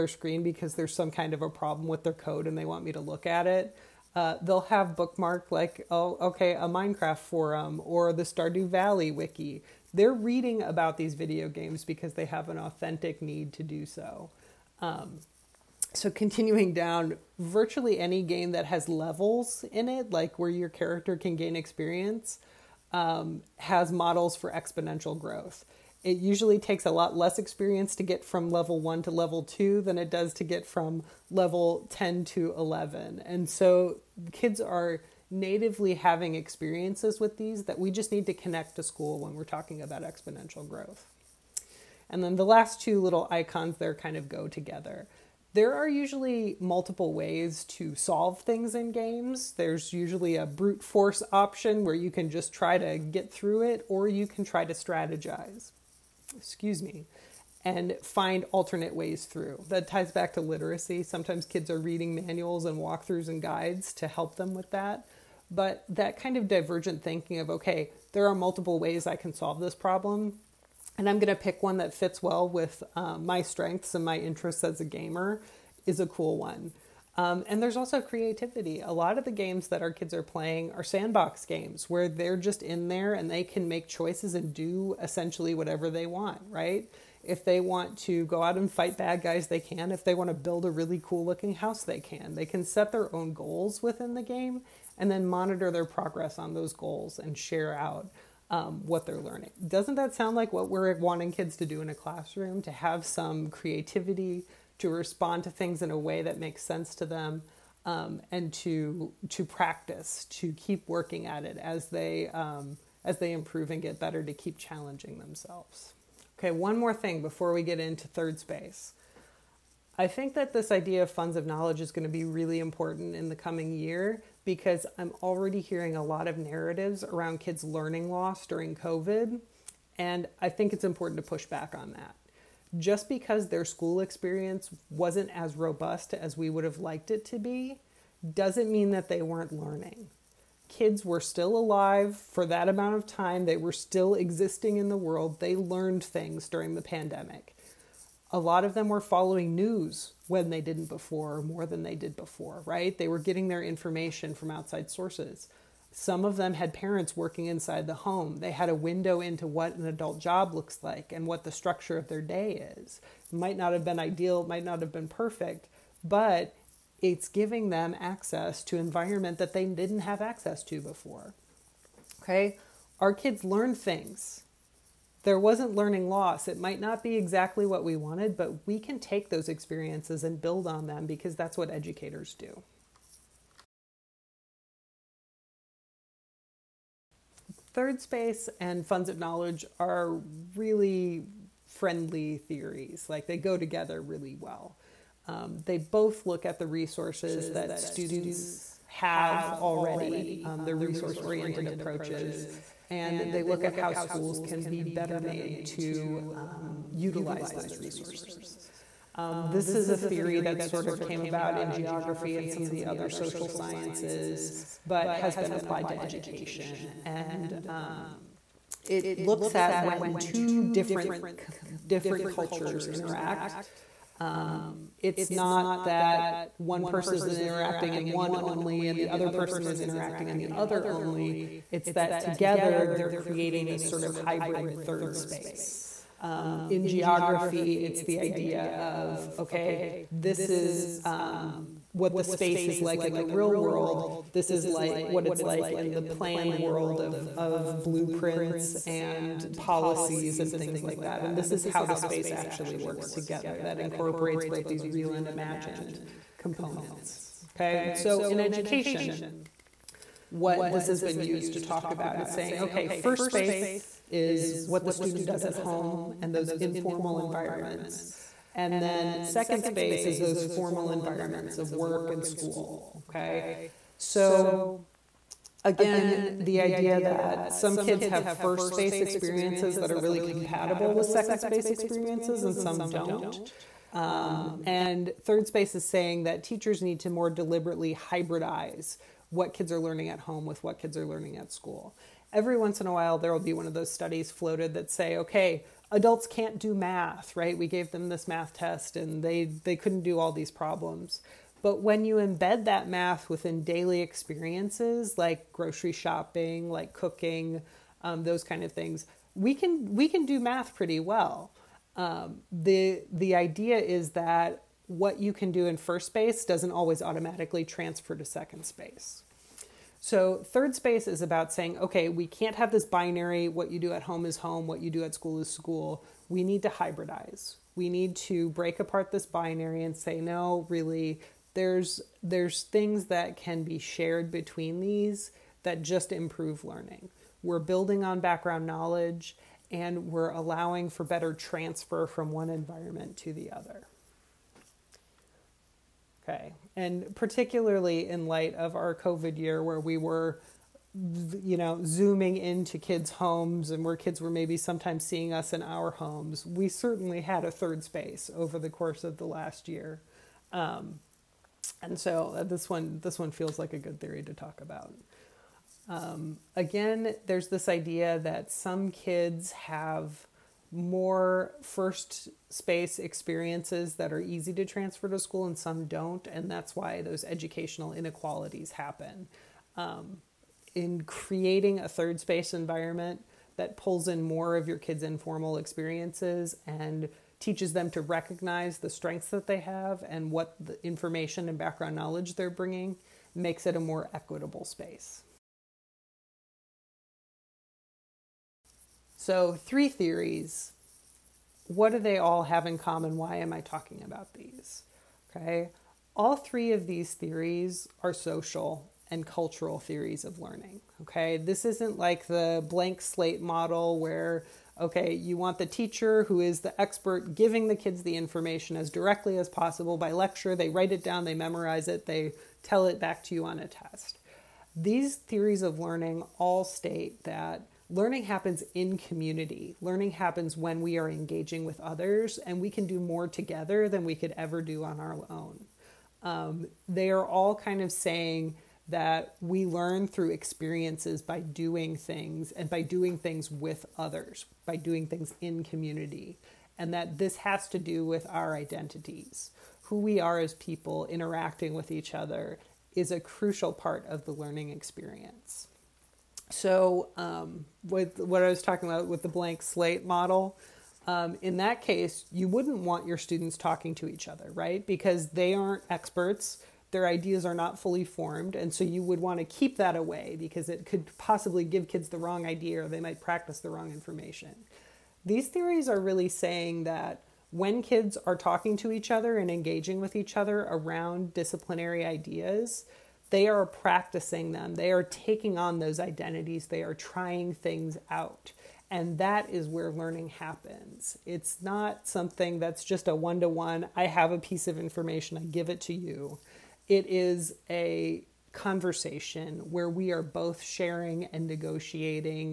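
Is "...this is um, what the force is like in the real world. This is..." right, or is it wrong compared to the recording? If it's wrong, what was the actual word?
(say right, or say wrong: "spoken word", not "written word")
wrong: "space", not "force".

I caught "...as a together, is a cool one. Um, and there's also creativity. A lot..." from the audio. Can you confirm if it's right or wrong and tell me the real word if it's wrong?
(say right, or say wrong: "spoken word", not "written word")
wrong: "gamer", not "together".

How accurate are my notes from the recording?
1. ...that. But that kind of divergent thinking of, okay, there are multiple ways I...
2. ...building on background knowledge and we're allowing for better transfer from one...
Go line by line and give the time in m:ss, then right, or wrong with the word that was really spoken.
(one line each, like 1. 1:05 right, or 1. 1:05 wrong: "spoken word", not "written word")
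1. 1:04 right
2. 5:37 right.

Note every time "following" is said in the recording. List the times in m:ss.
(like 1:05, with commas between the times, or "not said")
2:29.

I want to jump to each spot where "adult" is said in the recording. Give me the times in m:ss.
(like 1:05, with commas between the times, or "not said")
2:39, 4:55.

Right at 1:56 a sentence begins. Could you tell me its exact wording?
Okay, one more thing before we get into third space.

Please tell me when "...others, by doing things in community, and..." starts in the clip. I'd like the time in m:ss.
7:23.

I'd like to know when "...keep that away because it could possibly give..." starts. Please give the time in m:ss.
7:49.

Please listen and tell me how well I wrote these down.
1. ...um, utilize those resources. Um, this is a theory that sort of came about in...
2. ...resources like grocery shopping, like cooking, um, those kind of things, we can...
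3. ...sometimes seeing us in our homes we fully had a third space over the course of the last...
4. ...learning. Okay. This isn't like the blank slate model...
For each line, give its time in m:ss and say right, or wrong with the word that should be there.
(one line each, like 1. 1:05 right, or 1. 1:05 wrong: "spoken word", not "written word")
1. 3:26 right
2. 5:04 wrong: "experiences", not "resources"
3. 5:54 wrong: "certainly", not "fully"
4. 6:50 right.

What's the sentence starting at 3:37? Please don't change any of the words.
And um, it looks at when two different different cultures interact.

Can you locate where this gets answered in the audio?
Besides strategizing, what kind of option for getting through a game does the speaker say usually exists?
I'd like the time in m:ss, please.
0:50.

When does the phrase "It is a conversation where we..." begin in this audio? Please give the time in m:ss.
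8:16.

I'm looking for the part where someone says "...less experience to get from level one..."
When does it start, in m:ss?
0:27.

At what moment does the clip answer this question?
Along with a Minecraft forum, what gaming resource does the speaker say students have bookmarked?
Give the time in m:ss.
0:08.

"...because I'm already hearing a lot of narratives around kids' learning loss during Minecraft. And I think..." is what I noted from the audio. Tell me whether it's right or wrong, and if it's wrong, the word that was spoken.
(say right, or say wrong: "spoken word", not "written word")
wrong: "COVID", not "Minecraft".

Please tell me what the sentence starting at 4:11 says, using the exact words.
And this is how the space actually works together.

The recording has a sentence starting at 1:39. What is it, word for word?
Doesn't that sound like what we're wanting kids to do in a classroom?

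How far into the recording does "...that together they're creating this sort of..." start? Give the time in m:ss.
3:51.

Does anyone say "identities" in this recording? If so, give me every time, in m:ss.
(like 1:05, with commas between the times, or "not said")
7:28, 8:05.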